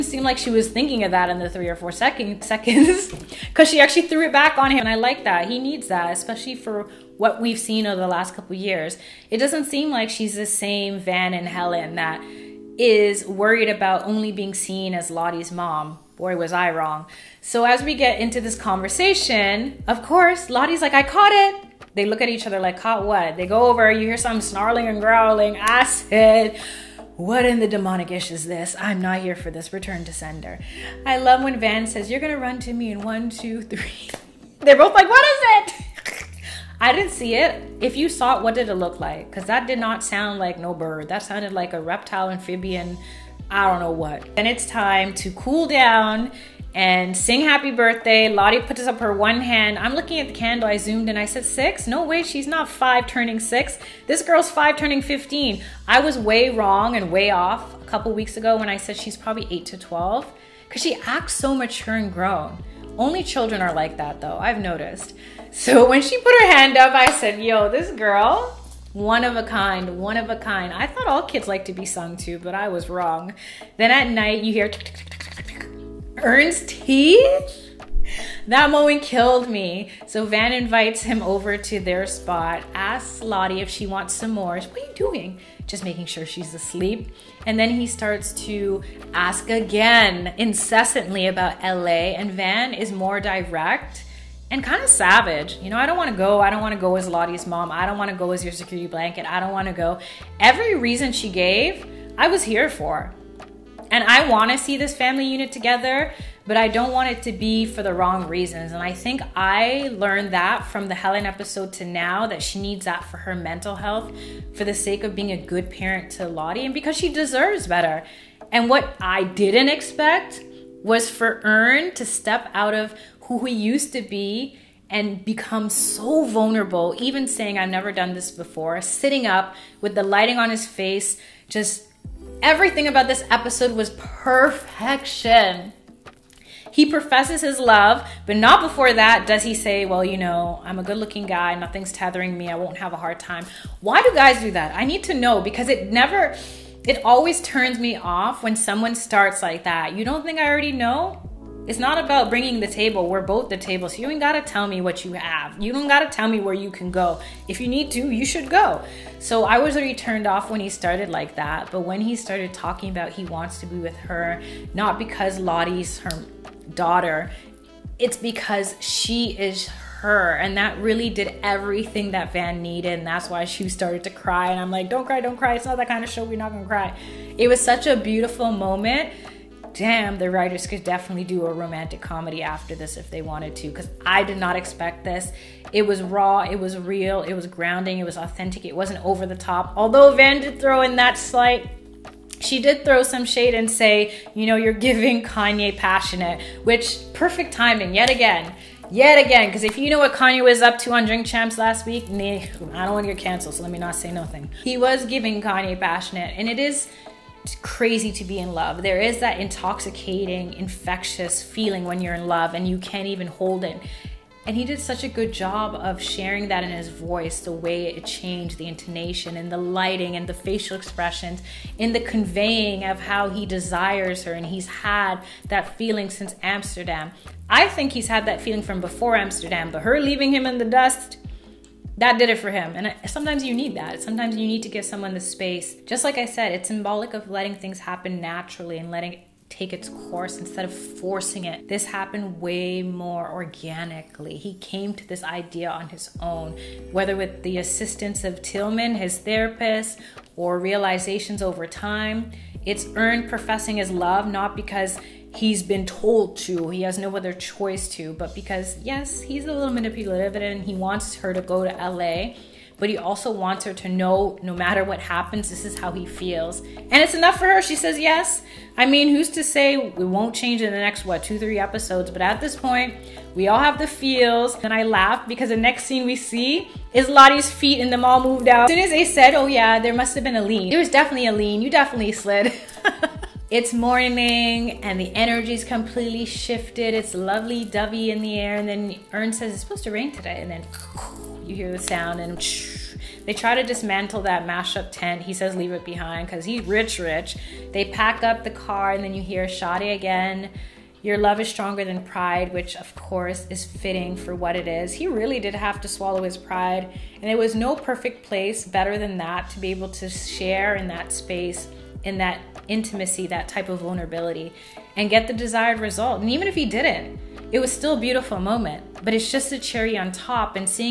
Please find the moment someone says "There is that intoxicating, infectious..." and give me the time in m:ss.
3:28.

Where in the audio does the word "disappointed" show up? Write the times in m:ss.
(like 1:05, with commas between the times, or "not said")
not said.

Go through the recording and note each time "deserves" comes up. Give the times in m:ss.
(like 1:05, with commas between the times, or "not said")
1:57.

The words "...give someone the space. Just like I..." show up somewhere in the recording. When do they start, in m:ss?
3:54.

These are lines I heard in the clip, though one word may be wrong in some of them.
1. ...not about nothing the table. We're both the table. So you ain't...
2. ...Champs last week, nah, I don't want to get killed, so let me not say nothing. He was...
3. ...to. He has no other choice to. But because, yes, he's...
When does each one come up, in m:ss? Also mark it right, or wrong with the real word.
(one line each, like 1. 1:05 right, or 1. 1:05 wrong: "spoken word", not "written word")
1. 2:31 wrong: "bringing", not "nothing"
2. 3:21 wrong: "canceled", not "killed"
3. 4:16 right.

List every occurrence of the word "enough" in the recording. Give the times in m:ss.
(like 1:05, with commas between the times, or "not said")
4:27.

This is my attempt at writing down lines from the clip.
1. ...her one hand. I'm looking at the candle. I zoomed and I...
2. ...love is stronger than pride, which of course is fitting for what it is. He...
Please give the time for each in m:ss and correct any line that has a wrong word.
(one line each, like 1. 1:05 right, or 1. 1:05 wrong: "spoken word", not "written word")
1. 0:48 right
2. 5:01 right.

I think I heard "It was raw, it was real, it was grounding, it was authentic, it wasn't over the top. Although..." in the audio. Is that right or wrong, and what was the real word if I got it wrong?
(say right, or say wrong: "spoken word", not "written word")
right.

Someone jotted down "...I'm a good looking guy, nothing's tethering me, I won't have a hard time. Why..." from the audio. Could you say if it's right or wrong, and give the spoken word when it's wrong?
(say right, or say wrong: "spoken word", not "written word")
right.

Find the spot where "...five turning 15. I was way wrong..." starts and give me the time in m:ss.
0:54.